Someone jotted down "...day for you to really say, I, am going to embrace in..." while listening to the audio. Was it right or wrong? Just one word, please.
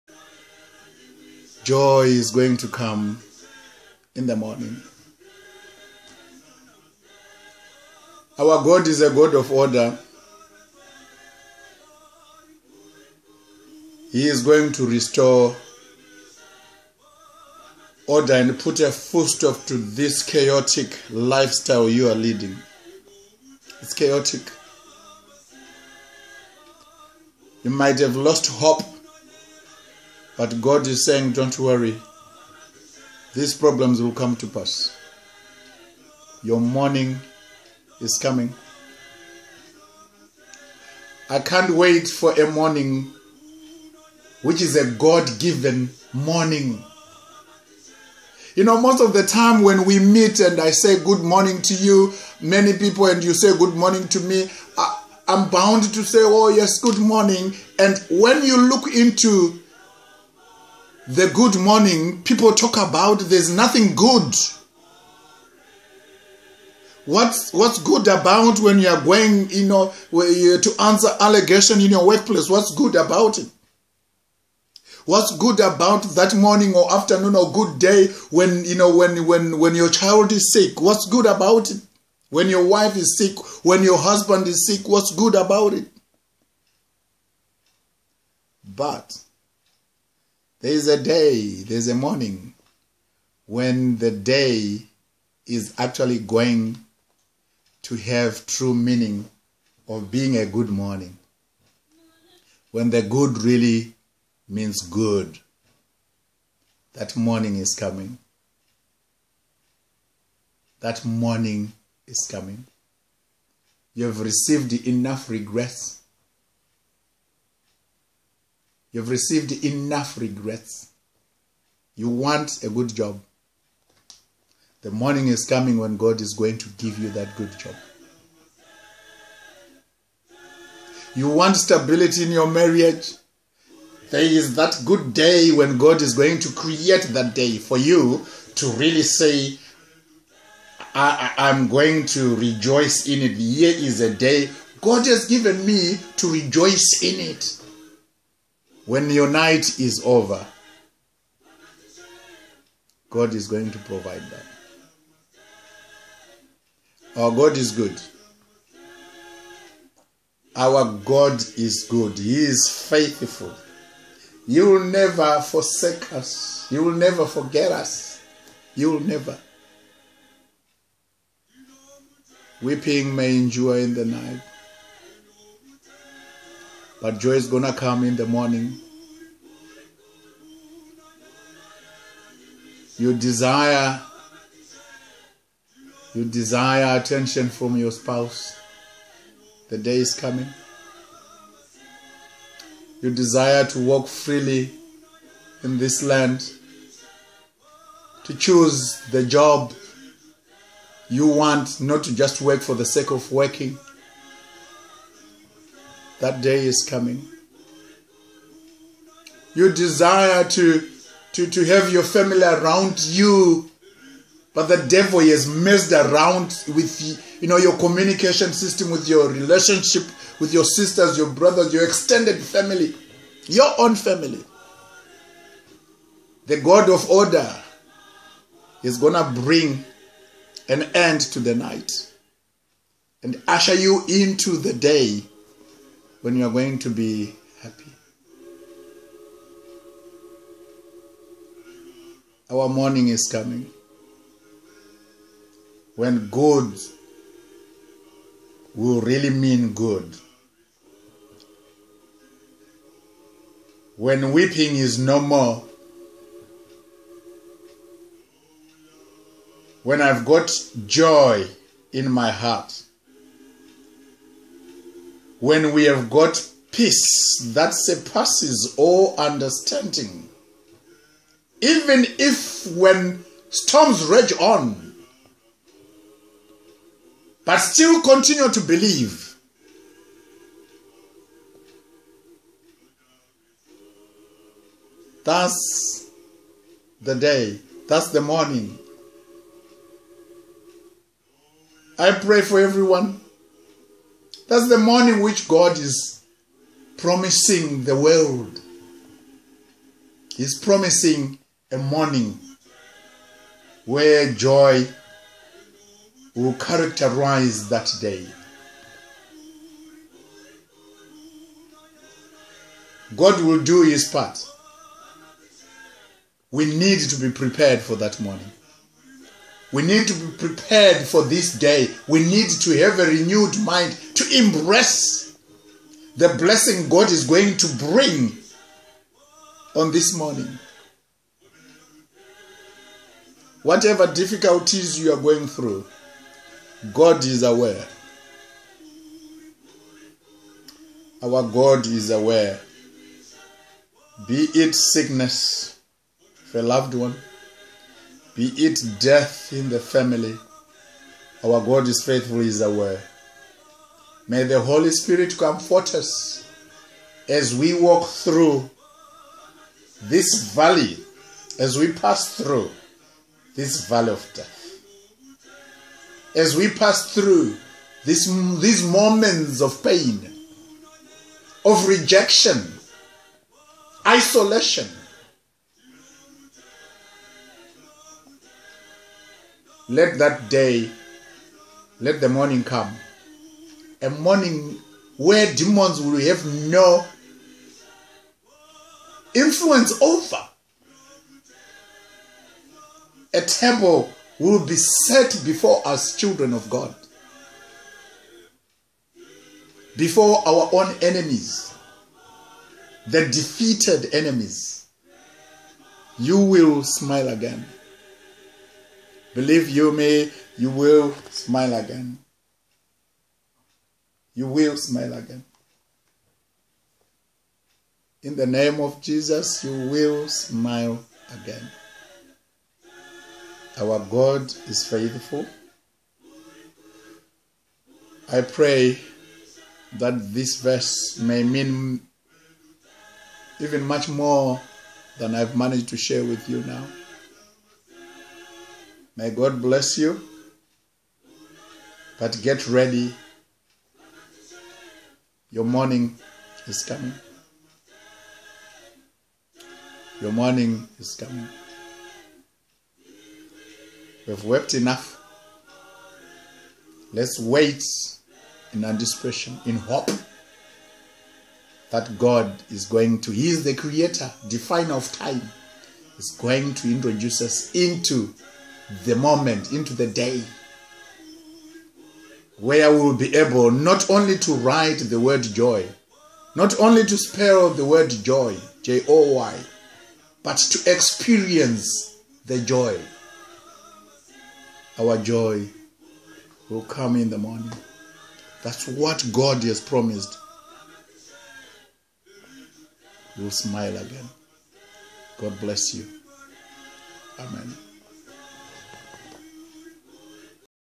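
wrong.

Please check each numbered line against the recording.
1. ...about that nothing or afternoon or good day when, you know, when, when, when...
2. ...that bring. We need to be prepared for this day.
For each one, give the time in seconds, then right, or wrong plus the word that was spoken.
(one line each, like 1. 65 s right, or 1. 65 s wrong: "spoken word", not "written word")
1. 75 s wrong: "morning", not "nothing"
2. 317 s wrong: "morning", not "bring".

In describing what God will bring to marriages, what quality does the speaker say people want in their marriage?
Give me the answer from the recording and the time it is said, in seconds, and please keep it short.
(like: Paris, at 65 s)
stability, at 131 s.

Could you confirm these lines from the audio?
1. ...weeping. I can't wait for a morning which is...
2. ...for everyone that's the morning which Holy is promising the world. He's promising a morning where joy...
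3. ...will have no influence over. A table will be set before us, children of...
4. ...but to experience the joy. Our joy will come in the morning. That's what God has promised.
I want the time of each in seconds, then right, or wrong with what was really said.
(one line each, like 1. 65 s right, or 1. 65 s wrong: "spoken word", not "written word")
1. 38 s wrong: "coming", not "weeping"
2. 292 s wrong: "God", not "Holy"
3. 386 s right
4. 480 s right.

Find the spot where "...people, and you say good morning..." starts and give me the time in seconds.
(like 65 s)
52 s.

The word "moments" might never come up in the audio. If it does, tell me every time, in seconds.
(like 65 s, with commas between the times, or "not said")
368 s, 469 s.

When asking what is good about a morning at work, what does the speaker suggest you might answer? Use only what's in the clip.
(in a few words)
allegation.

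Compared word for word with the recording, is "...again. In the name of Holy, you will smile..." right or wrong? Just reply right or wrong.
wrong.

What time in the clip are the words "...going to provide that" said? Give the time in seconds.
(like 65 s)
153 s.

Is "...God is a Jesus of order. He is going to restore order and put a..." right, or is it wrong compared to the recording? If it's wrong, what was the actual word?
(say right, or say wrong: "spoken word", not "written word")
wrong: "God", not "Jesus".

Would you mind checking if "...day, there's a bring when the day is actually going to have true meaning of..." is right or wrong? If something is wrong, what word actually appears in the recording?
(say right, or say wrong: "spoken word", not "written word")
wrong: "morning", not "bring".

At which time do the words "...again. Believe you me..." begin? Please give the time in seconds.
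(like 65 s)
407 s.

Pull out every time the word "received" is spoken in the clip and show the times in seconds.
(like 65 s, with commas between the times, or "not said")
114 s, 119 s.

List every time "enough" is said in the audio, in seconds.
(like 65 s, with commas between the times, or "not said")
114 s, 119 s, 454 s.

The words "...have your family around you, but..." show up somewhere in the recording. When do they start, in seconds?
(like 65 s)
211 s.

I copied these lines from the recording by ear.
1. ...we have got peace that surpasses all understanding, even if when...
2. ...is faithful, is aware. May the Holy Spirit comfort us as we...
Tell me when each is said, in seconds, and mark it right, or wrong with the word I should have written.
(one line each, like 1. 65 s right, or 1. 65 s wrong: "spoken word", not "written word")
1. 265 s right
2. 351 s right.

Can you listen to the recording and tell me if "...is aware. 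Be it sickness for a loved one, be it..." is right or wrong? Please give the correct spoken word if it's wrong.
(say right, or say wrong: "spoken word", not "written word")
right.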